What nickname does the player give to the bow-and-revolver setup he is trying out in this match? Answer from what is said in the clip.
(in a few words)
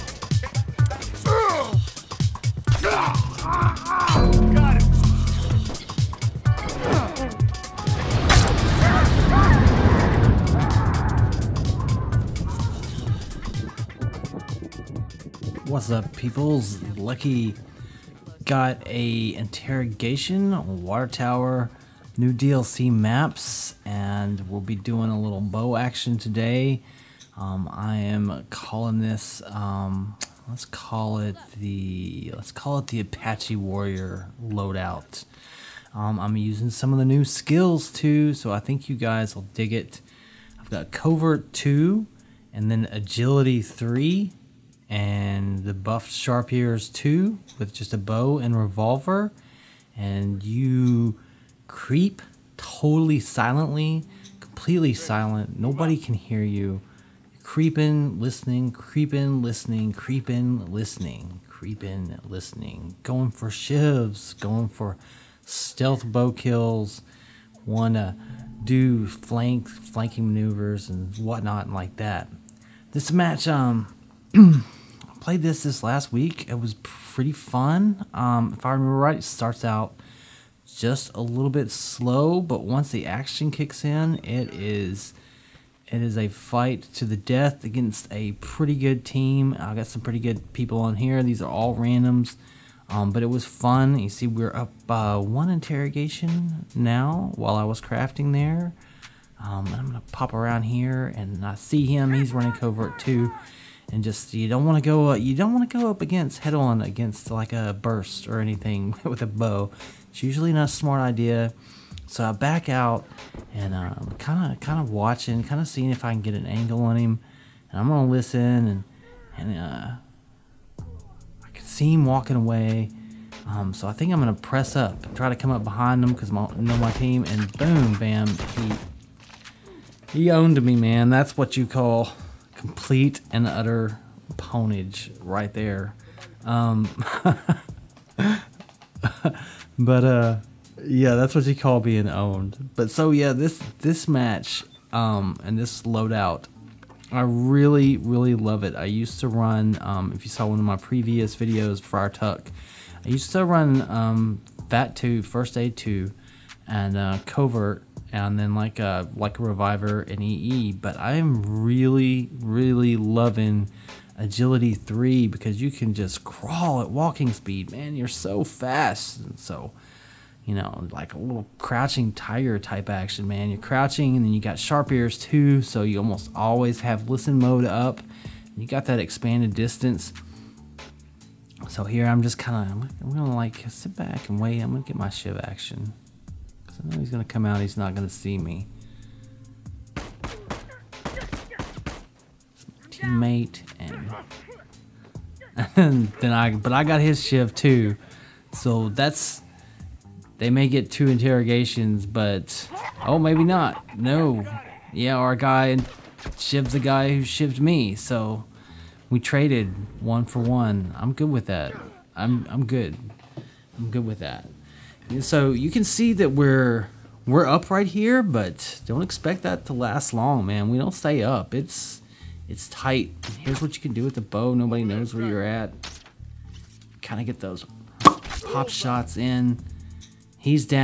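Apache Warrior loadout.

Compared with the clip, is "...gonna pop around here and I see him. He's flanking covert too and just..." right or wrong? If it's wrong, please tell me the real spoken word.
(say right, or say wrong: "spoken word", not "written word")
wrong: "running", not "flanking".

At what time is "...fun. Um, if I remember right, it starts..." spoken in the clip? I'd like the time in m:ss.
1:17.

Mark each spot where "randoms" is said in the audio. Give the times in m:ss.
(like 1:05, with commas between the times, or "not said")
1:31.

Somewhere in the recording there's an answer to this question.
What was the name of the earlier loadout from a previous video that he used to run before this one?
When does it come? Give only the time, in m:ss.
2:31.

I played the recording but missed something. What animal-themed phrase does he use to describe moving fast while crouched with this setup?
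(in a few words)
crouching tiger.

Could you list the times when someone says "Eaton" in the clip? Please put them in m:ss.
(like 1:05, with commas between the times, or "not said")
not said.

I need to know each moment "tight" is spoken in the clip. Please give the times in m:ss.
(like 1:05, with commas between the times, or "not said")
3:42.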